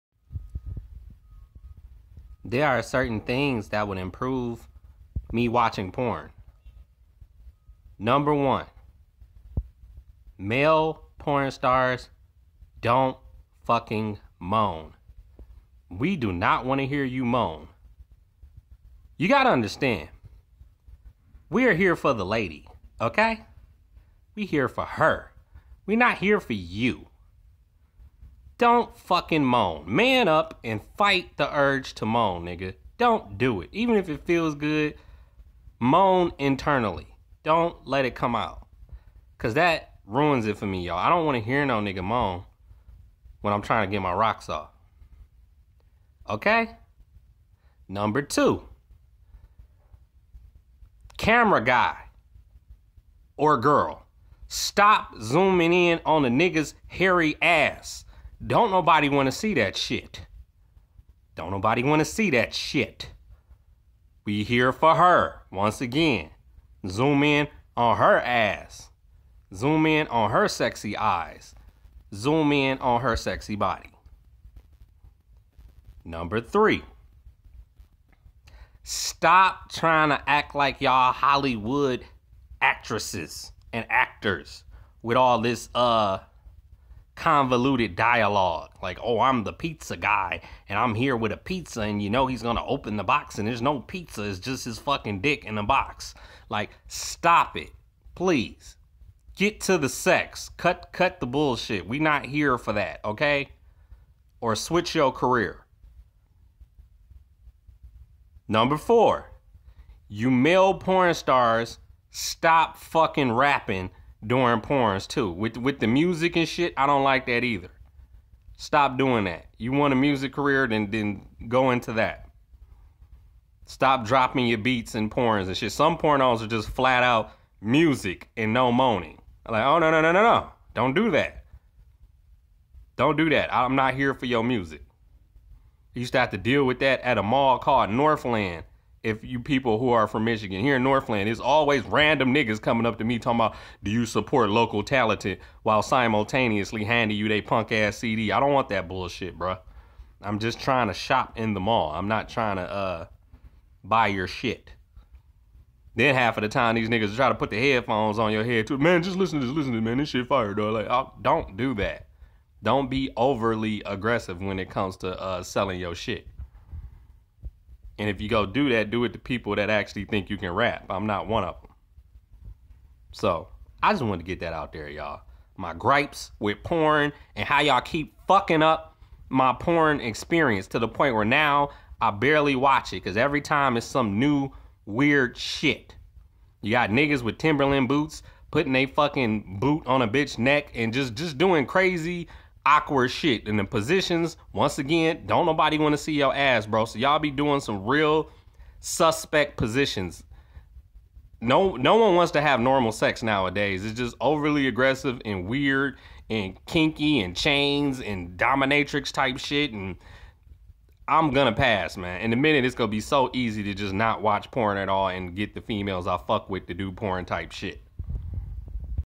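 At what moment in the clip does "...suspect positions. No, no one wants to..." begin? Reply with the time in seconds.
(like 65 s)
198 s.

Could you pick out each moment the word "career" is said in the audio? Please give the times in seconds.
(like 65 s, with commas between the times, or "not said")
105 s, 120 s.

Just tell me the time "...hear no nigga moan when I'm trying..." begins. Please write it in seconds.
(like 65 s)
41 s.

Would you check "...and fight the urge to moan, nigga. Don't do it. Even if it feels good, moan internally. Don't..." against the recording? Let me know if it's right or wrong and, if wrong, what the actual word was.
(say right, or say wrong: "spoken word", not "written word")
right.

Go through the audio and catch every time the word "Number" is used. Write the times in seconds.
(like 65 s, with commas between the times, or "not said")
7 s, 47 s, 76 s, 108 s.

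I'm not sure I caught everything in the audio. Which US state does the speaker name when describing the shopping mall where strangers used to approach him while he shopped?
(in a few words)
Michigan.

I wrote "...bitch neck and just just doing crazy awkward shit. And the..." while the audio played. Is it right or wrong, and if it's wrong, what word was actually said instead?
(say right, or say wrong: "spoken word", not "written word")
right.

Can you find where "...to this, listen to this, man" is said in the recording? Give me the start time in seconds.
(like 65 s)
159 s.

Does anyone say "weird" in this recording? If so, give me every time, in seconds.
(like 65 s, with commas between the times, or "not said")
184 s, 205 s.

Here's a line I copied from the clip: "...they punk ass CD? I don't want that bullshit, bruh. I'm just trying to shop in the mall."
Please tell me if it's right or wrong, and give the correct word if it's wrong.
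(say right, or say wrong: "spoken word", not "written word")
right.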